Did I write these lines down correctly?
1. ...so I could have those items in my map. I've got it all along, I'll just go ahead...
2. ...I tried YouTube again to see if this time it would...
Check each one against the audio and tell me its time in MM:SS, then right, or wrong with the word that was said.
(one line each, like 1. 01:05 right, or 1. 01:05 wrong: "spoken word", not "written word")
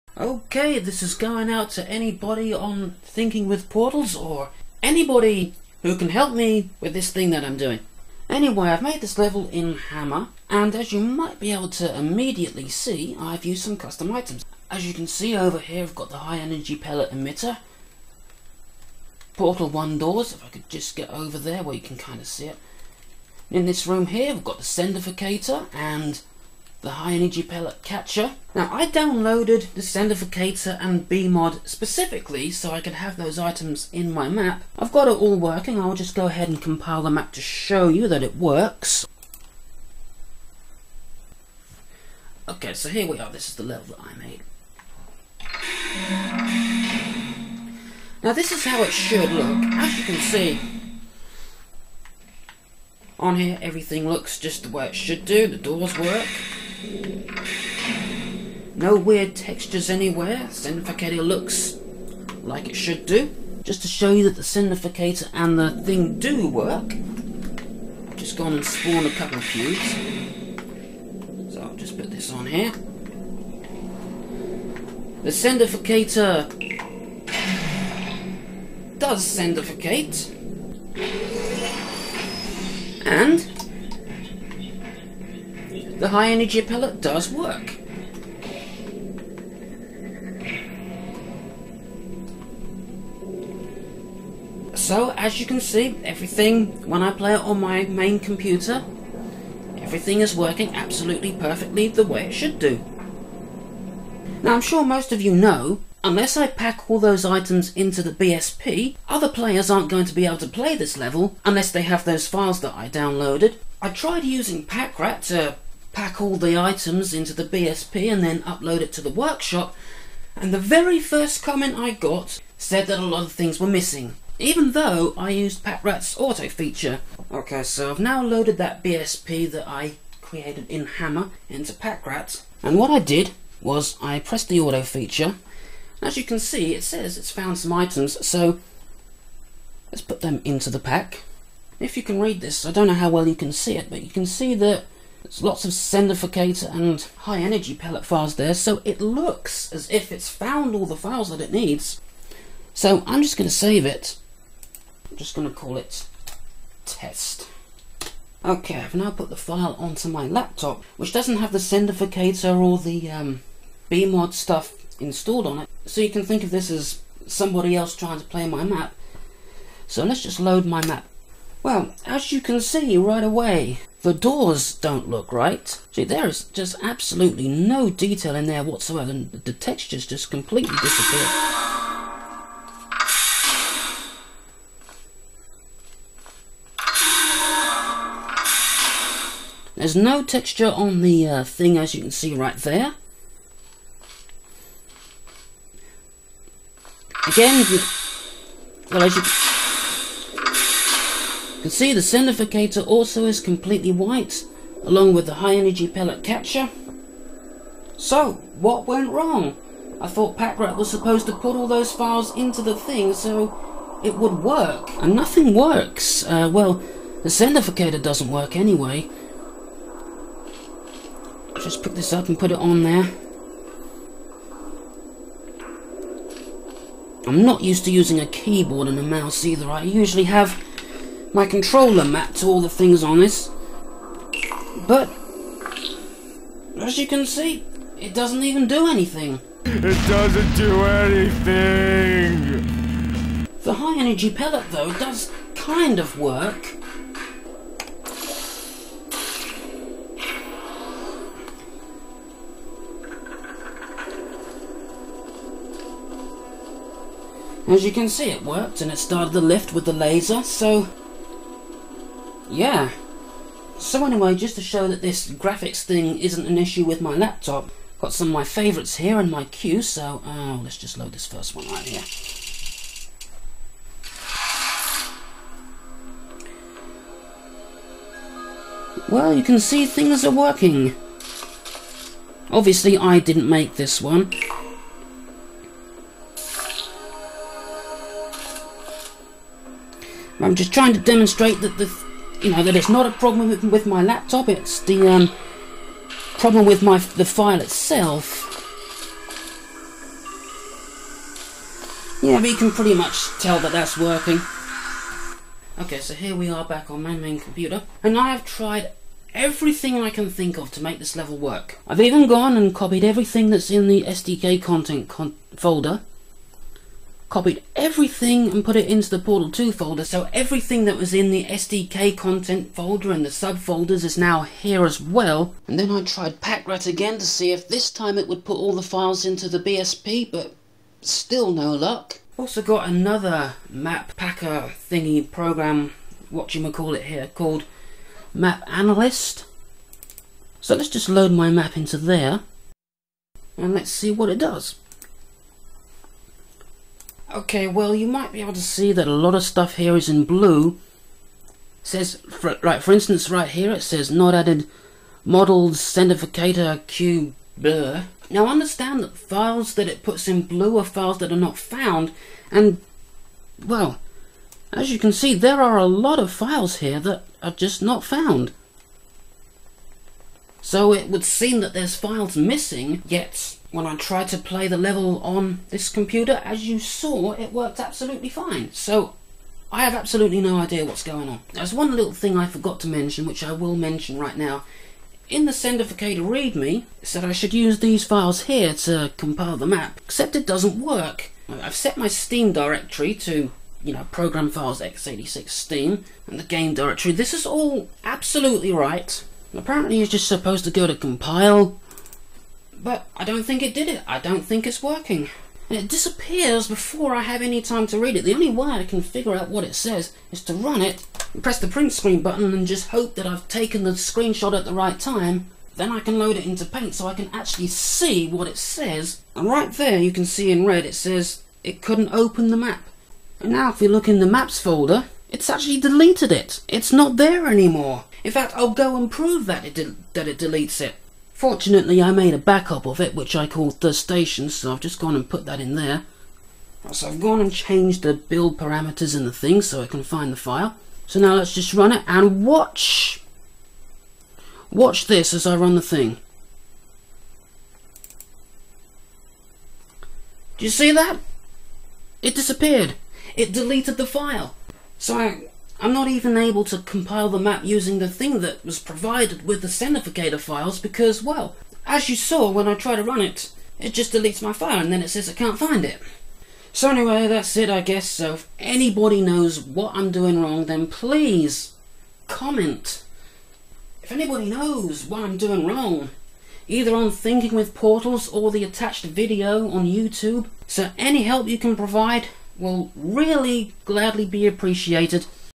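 1. 00:32 wrong: "working", not "along"
2. 05:25 wrong: "PackRat", not "YouTube".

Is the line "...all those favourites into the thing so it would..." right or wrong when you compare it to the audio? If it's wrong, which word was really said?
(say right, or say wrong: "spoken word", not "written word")
wrong: "files", not "favourites".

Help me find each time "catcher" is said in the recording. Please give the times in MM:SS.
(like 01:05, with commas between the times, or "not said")
00:27, 03:26.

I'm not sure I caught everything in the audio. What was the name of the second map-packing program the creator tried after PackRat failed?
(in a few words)
Map Analyst.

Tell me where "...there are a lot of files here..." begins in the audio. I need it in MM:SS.
06:05.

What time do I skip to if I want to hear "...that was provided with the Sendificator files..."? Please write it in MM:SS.
07:38.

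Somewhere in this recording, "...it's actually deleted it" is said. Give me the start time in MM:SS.
07:05.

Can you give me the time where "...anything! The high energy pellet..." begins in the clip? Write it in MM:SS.
04:00.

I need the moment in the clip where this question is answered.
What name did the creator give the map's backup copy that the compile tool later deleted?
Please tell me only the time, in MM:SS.
07:13.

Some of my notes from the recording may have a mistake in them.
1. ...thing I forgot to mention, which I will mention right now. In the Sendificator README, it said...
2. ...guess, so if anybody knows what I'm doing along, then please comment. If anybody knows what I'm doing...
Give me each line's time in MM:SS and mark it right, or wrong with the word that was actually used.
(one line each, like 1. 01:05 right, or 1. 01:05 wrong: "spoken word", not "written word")
1. 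06:22 right
2. 07:47 wrong: "wrong", not "along".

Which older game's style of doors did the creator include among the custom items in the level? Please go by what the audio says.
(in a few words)
Portal one.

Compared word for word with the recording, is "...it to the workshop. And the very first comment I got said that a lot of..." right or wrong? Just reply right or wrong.
right.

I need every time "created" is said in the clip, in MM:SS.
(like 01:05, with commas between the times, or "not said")
02:10.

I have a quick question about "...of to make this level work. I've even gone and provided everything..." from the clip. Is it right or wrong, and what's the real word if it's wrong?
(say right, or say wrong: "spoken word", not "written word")
wrong: "copied", not "provided".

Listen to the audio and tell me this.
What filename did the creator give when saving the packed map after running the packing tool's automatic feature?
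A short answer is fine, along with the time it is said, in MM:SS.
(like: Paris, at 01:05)
test, at 02:36.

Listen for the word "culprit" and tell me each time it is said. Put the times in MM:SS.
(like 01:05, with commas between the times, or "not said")
not said.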